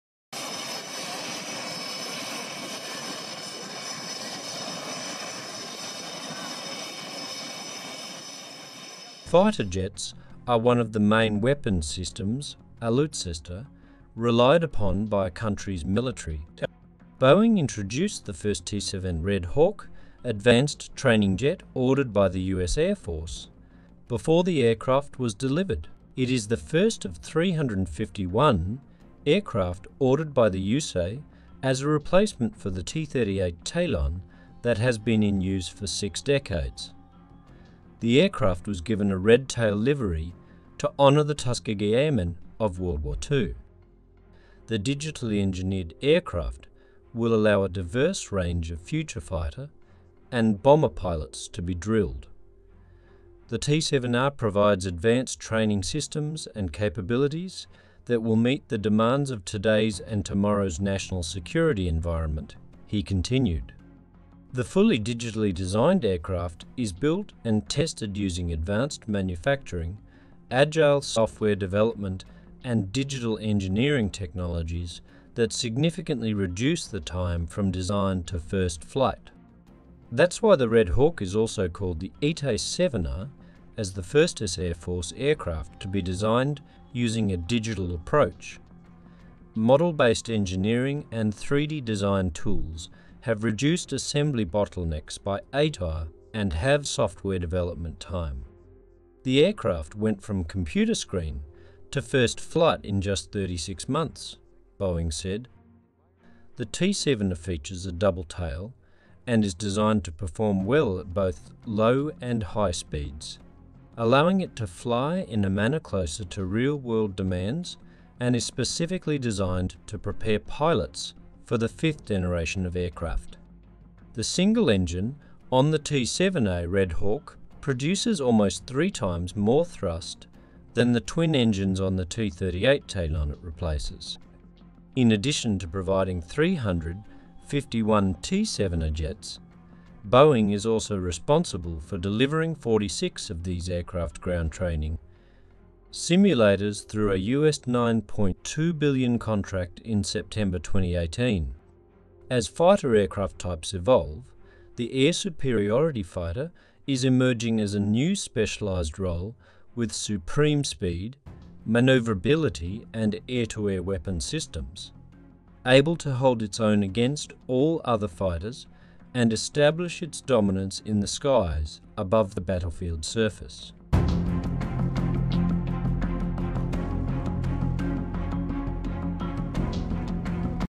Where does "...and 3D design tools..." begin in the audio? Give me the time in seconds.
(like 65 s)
91 s.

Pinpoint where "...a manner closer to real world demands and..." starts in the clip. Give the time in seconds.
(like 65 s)
115 s.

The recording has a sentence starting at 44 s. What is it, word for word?
The digitally engineered aircraft will allow a diverse range of future fighter and bomber pilots to be drilled.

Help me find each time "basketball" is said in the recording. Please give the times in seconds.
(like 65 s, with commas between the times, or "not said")
not said.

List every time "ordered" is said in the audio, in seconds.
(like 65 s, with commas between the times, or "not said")
21 s, 29 s.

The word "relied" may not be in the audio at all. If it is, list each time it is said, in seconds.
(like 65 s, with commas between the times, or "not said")
14 s.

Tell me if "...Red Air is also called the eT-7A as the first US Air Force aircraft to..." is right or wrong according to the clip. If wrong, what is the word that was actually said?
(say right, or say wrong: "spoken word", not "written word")
wrong: "Hawk", not "Air".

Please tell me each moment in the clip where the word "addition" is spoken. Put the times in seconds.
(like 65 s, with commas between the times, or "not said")
135 s.